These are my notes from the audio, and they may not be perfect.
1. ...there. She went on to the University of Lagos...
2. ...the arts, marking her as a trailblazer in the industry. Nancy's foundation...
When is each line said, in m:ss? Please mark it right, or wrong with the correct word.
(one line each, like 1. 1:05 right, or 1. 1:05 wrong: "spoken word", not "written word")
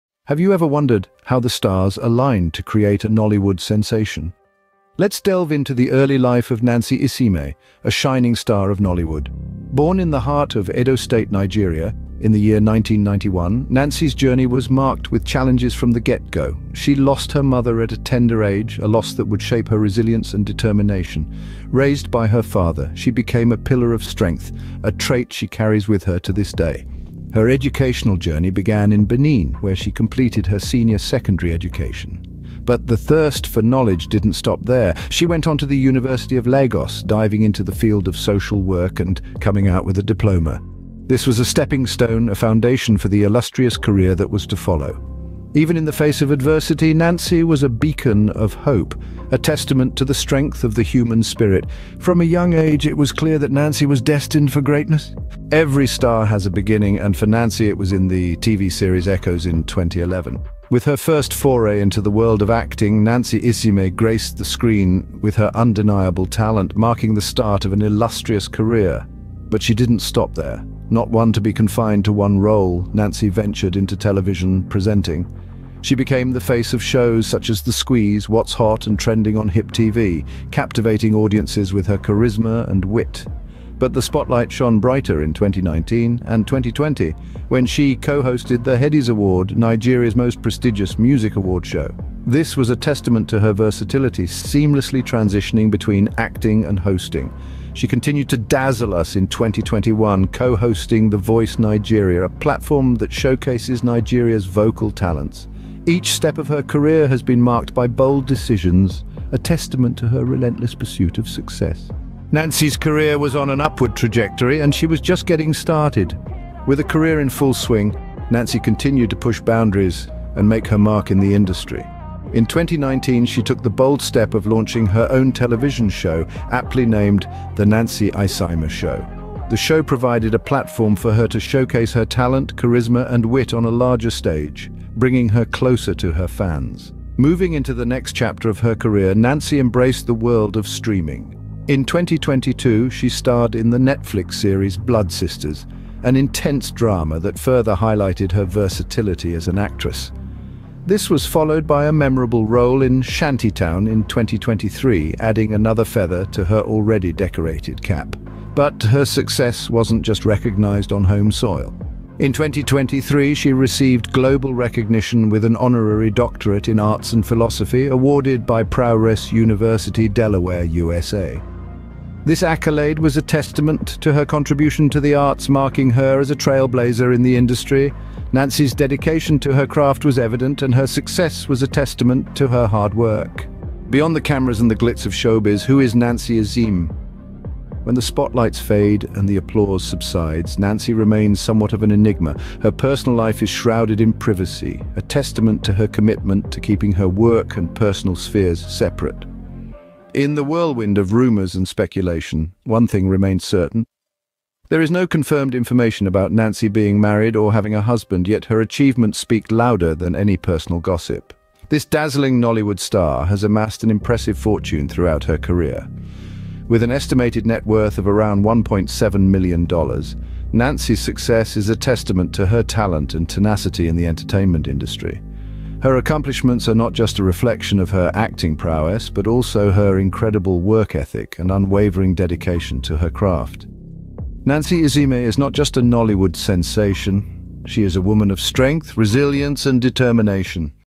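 1. 0:34 right
2. 2:54 wrong: "dedication", not "foundation".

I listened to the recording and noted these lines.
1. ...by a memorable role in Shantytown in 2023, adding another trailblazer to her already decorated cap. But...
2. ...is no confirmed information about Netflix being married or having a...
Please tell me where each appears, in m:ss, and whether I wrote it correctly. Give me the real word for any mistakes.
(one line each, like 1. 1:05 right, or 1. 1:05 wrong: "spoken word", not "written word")
1. 2:31 wrong: "feather", not "trailblazer"
2. 3:24 wrong: "Nancy", not "Netflix".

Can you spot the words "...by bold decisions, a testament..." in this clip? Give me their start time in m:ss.
1:47.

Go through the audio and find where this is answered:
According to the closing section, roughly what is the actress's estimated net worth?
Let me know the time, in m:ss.
3:38.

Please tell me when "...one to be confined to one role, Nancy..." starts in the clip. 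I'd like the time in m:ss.
1:11.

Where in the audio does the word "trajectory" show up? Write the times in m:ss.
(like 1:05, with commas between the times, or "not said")
1:53.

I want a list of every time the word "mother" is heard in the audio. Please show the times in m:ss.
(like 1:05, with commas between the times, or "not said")
0:17.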